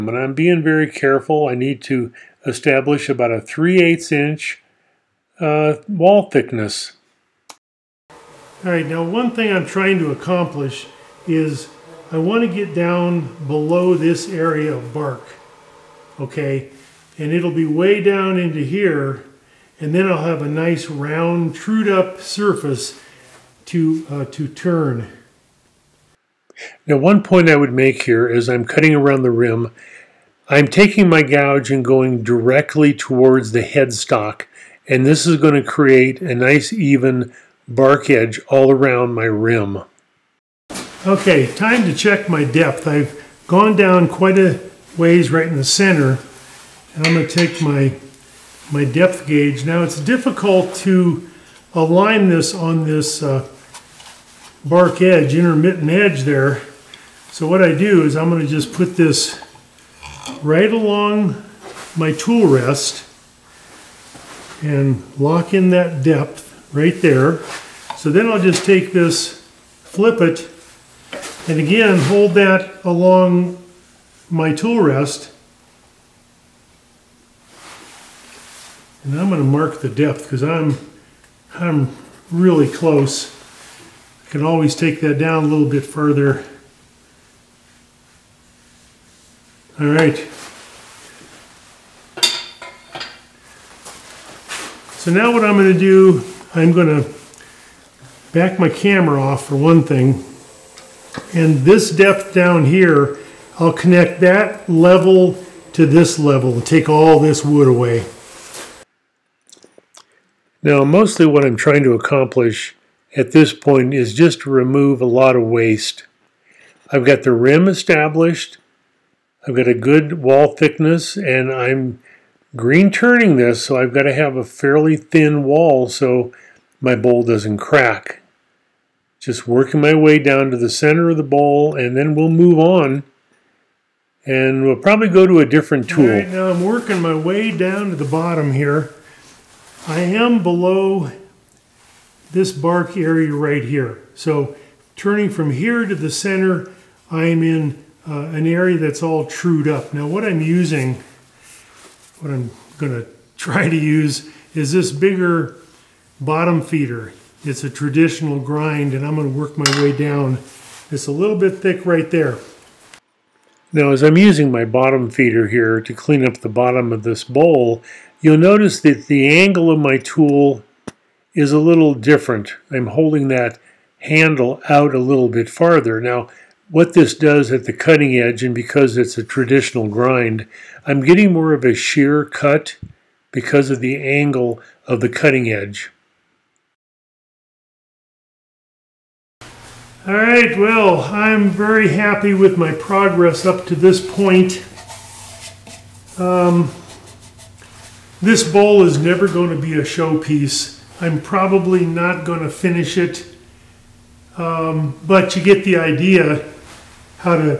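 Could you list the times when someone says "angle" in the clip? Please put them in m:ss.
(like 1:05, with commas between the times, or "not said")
2:49, 3:03.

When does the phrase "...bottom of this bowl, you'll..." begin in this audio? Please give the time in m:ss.
2:46.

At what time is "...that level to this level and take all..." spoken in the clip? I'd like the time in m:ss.
1:44.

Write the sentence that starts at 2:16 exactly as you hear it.
Right, now I'm working my way down to the bottom here.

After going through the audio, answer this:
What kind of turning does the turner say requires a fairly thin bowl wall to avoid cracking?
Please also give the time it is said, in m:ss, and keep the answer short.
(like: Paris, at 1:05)
green turning, at 2:02.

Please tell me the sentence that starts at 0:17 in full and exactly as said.
And it'll be way down into here, and then I'll have a nice round, trued up surface to, uh, to turn.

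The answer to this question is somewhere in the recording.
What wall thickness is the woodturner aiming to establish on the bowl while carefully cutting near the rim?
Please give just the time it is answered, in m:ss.
0:03.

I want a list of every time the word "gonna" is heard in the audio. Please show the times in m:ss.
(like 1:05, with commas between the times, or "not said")
2:32, 2:39.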